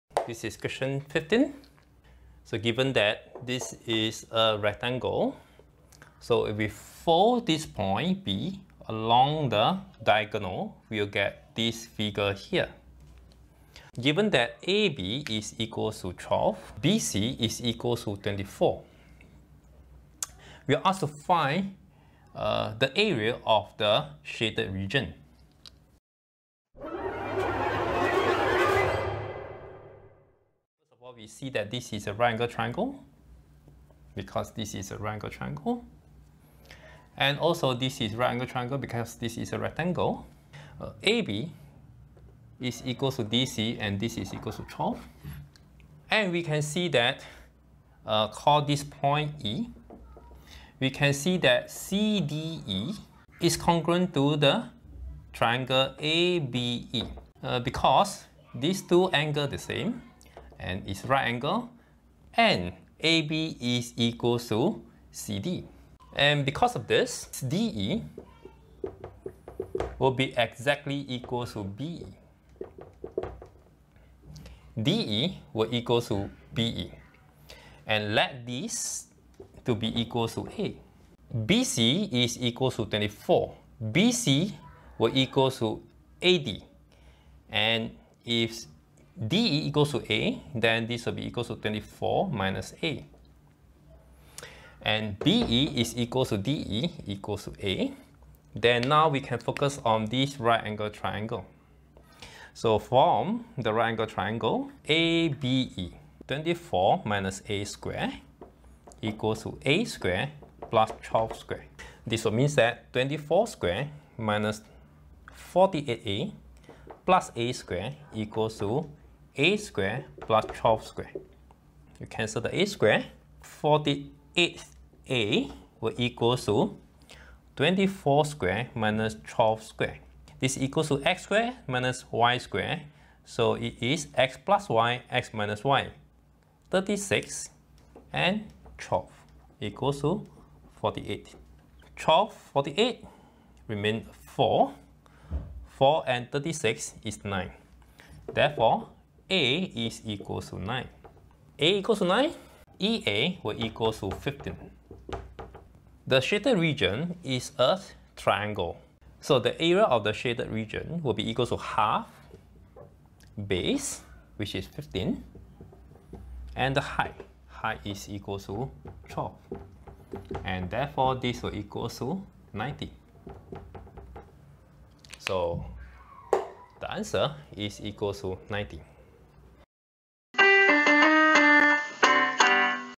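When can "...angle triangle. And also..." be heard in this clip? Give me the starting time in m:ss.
0:35.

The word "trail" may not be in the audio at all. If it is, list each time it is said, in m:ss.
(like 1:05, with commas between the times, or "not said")
not said.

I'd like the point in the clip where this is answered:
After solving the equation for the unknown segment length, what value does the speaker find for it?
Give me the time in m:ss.
2:29.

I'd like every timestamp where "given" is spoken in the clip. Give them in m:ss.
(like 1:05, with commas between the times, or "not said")
0:02, 0:13.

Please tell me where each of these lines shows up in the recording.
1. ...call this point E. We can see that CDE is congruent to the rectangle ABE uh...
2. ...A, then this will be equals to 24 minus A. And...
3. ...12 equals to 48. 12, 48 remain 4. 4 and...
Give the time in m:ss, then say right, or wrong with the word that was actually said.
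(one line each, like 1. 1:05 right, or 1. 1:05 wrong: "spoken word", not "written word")
1. 0:48 wrong: "triangle", not "rectangle"
2. 1:30 right
3. 2:18 right.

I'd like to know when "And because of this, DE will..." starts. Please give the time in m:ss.
1:06.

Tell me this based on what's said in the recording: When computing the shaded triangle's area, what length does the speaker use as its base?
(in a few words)
15.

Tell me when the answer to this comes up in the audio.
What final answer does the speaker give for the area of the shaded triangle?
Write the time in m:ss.
2:56.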